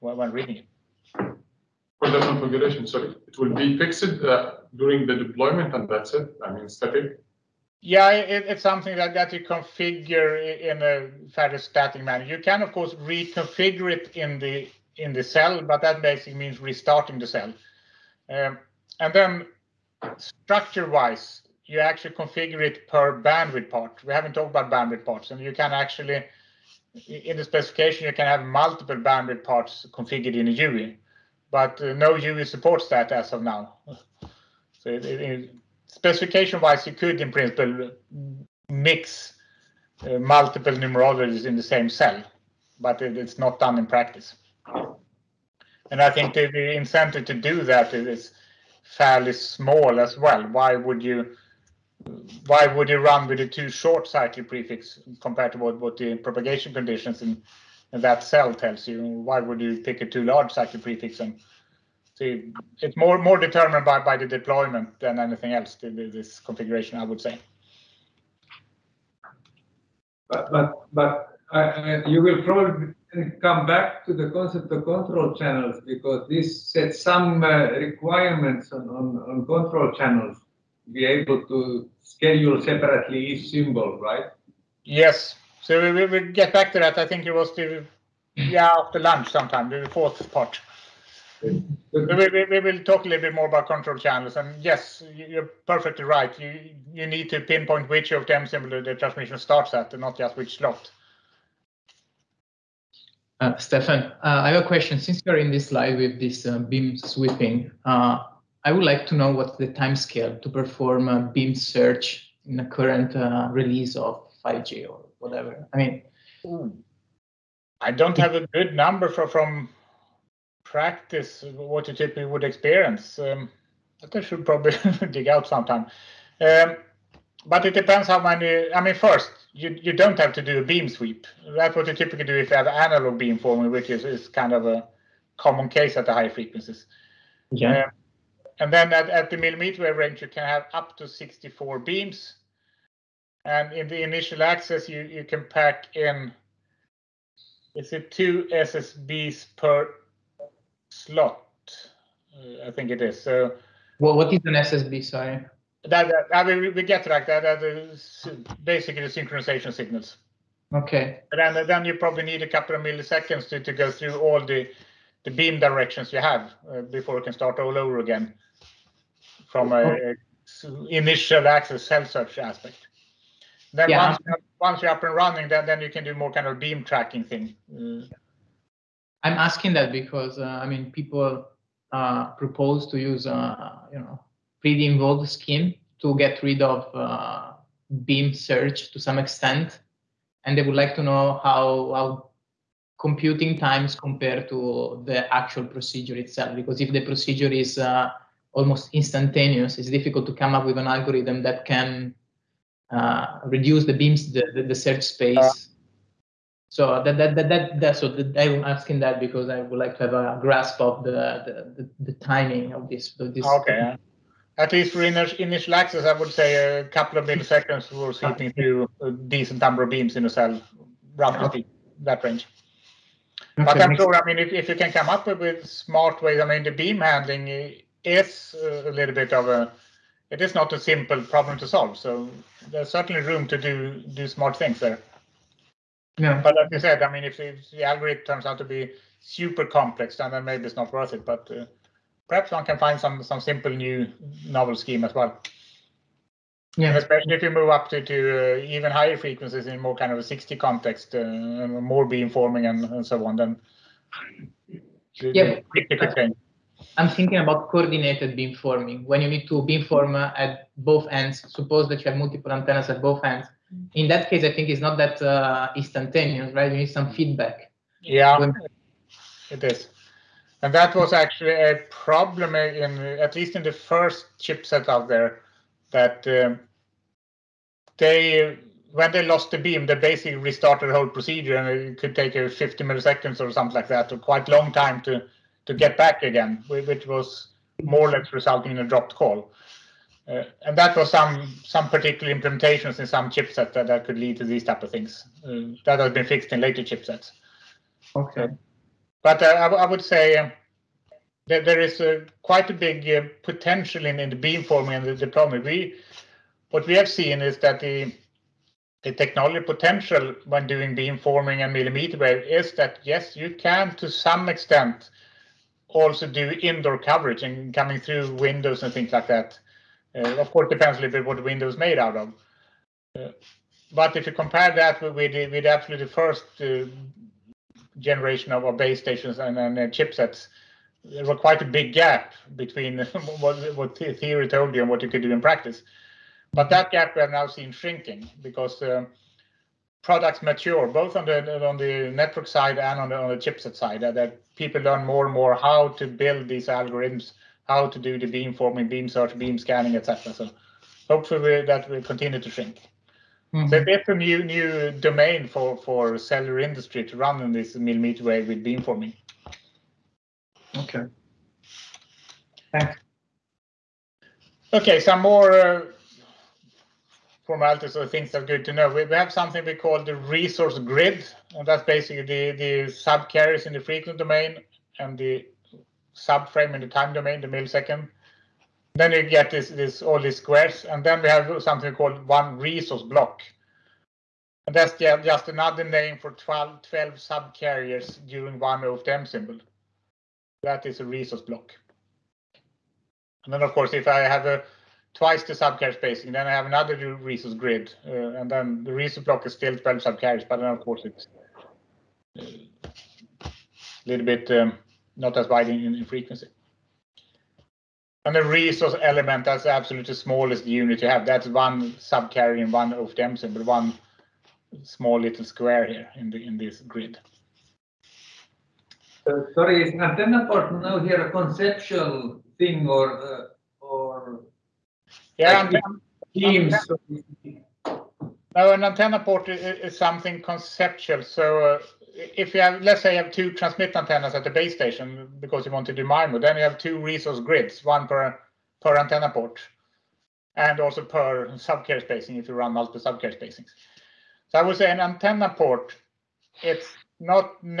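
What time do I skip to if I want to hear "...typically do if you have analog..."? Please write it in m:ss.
2:11.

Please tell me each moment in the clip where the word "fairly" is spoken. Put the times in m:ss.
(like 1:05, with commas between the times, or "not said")
0:11, 0:48.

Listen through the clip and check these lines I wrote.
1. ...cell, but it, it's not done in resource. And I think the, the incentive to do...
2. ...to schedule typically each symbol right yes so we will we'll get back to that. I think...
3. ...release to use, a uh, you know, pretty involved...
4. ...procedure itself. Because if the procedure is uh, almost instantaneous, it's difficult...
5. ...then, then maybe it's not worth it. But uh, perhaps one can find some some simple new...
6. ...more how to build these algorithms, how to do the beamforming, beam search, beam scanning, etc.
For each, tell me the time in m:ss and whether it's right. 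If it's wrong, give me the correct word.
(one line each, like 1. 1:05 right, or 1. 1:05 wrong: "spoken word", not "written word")
1. 0:41 wrong: "practice", not "resource"
2. 1:21 wrong: "separately", not "typically"
3. 3:02 wrong: "propose", not "release"
4. 3:15 right
5. 4:00 right
6. 5:45 right.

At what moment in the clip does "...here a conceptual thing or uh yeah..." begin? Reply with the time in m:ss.
7:00.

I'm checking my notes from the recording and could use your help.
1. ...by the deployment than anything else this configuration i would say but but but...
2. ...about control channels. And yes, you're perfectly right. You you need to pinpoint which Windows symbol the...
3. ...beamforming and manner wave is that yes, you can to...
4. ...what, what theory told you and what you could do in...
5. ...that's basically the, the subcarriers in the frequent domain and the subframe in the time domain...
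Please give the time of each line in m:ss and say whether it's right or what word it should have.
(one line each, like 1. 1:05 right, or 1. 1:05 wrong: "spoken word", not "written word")
1. 1:04 right
2. 1:33 wrong: "OFDM", not "Windows"
3. 5:10 wrong: "millimeter", not "manner"
4. 5:33 right
5. 6:11 right.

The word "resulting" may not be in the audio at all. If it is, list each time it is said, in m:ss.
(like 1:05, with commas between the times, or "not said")
4:48.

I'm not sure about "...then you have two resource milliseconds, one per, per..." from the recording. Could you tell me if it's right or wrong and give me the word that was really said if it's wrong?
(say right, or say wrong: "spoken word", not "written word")
wrong: "grids", not "milliseconds".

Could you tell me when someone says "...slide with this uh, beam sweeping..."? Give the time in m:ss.
1:45.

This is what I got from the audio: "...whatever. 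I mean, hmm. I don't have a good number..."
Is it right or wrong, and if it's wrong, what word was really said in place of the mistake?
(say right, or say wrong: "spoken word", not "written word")
right.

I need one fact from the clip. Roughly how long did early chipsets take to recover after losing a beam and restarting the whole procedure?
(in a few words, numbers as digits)
50 milliseconds.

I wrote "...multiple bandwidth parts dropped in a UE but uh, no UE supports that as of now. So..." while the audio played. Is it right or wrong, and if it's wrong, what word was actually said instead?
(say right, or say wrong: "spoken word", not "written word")
wrong: "configured", not "dropped".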